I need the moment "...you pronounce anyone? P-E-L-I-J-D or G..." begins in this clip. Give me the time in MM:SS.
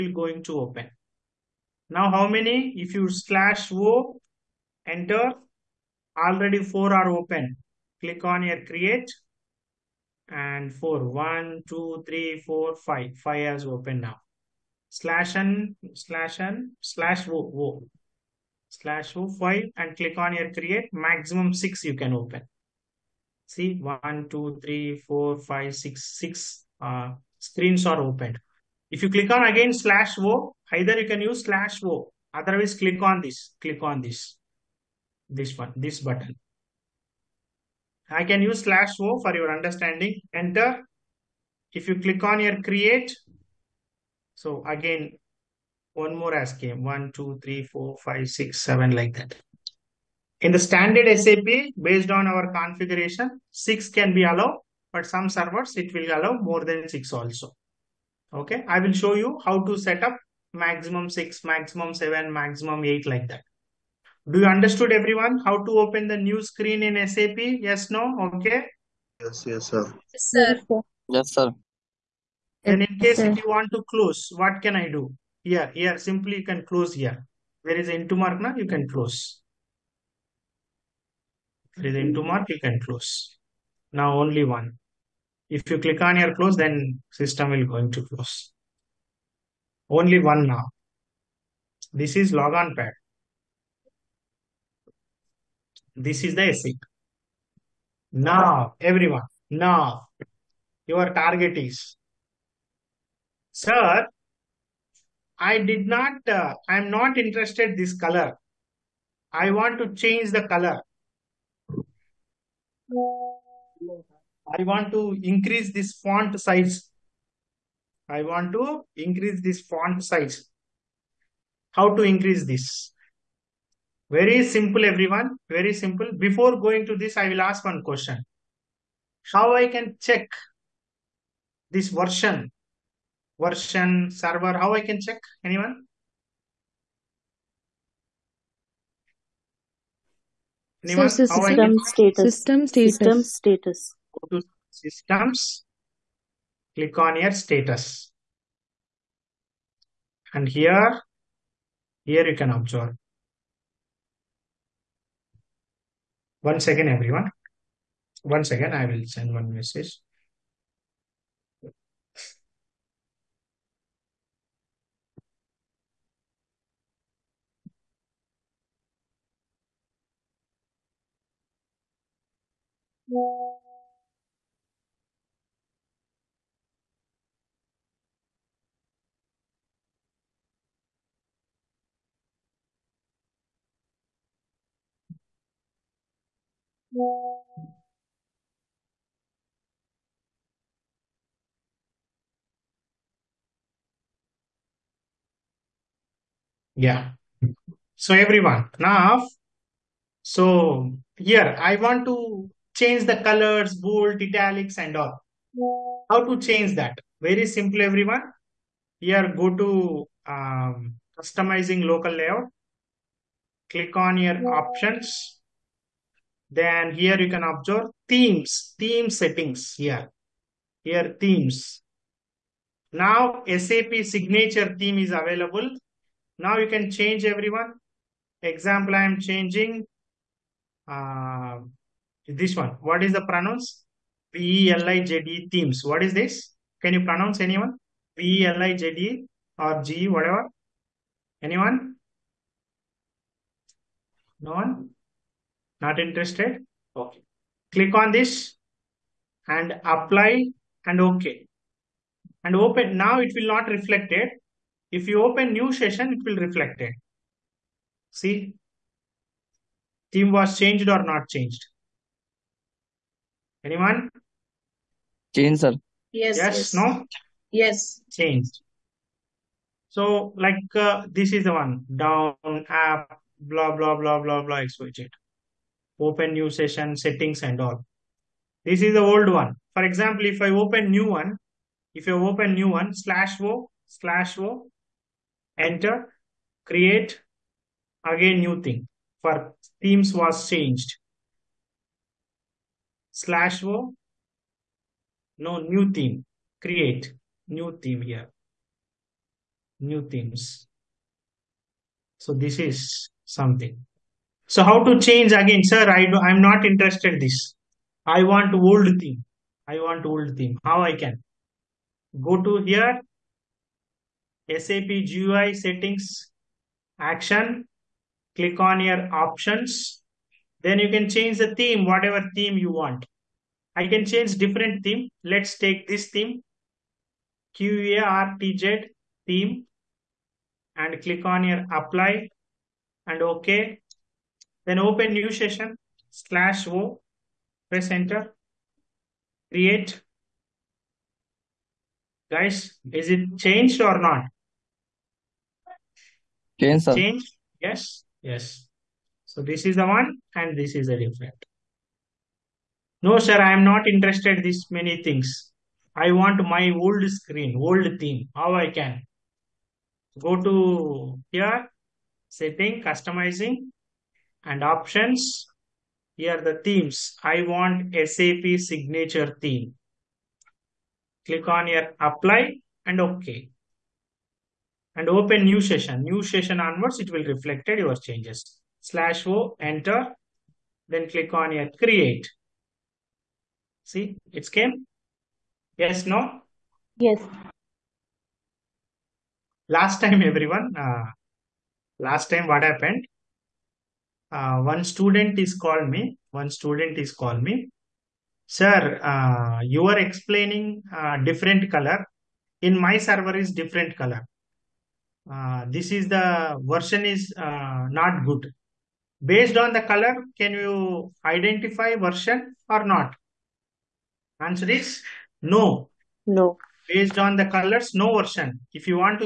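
03:56.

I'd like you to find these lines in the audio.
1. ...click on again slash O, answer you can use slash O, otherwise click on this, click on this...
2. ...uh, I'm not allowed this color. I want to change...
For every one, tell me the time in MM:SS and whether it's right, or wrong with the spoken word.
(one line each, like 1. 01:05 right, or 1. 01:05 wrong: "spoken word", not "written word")
1. 00:29 wrong: "either", not "answer"
2. 01:46 wrong: "interested", not "allowed".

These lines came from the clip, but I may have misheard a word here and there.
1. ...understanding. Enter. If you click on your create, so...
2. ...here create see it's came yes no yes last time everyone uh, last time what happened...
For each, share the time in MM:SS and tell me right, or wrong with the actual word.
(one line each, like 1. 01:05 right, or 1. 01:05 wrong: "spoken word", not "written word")
1. 00:39 right
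2. 06:21 right.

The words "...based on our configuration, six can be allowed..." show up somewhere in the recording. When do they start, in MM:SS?
00:51.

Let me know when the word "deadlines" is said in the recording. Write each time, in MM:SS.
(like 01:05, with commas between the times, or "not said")
not said.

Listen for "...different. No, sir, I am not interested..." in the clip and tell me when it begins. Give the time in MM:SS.
05:50.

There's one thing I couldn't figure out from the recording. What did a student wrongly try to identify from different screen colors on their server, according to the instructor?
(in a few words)
The version.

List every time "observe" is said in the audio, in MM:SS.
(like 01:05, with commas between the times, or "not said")
02:32, 03:37.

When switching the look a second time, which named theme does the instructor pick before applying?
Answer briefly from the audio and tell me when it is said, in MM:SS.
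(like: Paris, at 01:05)
Quartz theme, at 05:27.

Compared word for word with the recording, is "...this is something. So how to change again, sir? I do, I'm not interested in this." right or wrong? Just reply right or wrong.
right.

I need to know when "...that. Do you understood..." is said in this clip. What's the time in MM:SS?
01:03.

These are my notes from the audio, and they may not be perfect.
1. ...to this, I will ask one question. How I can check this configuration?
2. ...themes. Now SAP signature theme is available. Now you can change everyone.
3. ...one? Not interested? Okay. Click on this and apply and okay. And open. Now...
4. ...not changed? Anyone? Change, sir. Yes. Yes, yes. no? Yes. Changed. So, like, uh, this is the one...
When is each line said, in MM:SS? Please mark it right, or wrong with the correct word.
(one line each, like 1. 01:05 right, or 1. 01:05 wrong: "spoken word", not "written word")
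1. 02:06 wrong: "version", not "configuration"
2. 03:41 right
3. 04:04 right
4. 04:21 right.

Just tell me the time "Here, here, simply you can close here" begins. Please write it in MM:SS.
01:15.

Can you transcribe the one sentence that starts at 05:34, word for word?
Then open new session, slash O, press enter, create.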